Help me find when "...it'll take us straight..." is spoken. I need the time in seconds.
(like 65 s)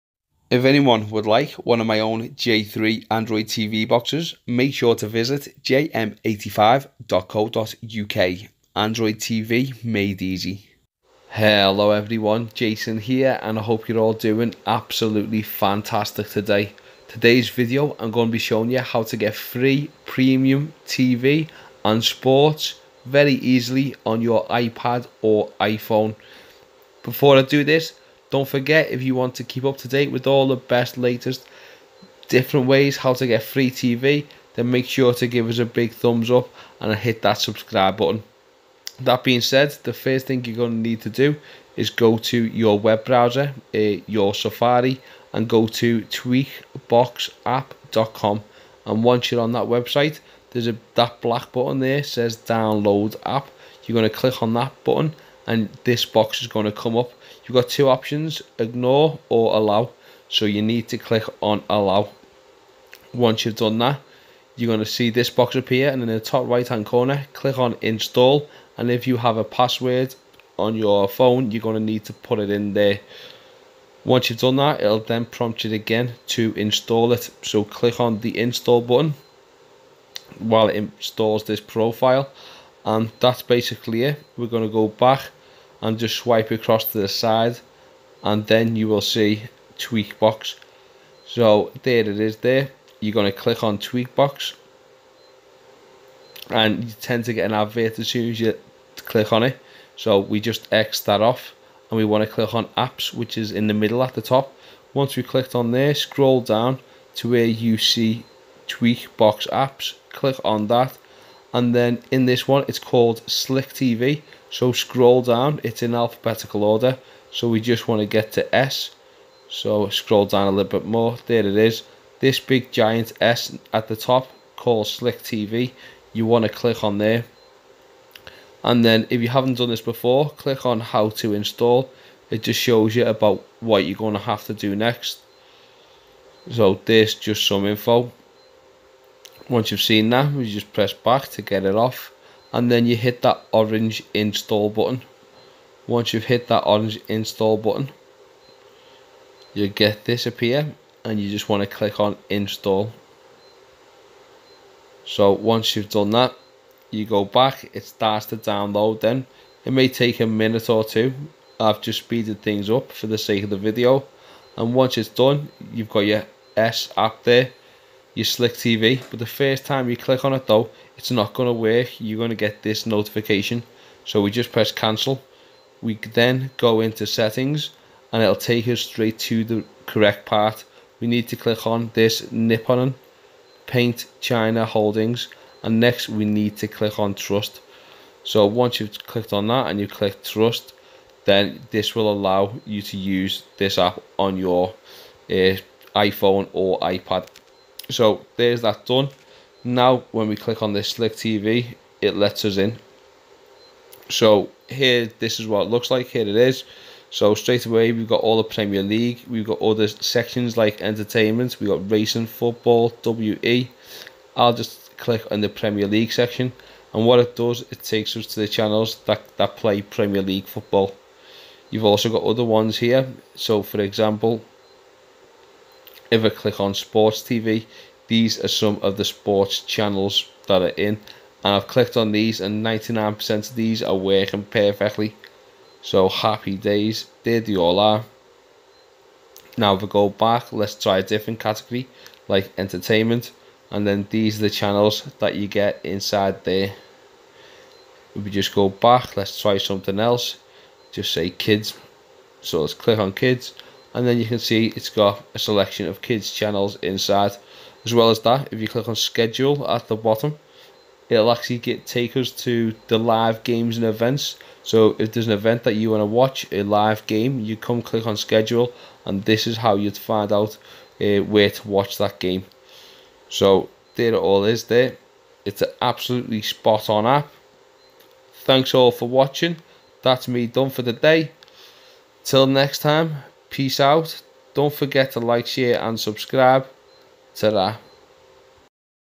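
178 s.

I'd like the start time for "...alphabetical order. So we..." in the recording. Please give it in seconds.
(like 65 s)
115 s.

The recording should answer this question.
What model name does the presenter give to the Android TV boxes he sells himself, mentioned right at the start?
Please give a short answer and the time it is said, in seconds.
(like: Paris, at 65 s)
J3, at 2 s.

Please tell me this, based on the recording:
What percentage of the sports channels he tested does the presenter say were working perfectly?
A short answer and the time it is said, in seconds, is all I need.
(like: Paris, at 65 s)
99%, at 232 s.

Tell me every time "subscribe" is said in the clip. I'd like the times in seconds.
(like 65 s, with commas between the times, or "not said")
37 s, 285 s.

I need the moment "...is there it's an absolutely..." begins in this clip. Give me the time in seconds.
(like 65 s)
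274 s.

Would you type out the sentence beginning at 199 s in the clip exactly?
Now when we click on this Slick TV, it lets us in.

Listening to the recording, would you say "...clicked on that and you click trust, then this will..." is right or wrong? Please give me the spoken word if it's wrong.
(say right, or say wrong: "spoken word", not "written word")
right.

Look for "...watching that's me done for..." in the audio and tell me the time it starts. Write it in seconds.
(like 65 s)
279 s.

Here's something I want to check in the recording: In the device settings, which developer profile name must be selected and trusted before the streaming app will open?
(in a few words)
Nippon Paint China Holdings.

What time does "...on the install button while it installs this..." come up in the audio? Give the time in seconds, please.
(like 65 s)
77 s.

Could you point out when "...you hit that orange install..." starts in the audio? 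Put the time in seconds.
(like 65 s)
142 s.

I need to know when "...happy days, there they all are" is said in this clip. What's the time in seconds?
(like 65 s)
236 s.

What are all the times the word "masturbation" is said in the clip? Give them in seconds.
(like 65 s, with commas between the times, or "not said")
not said.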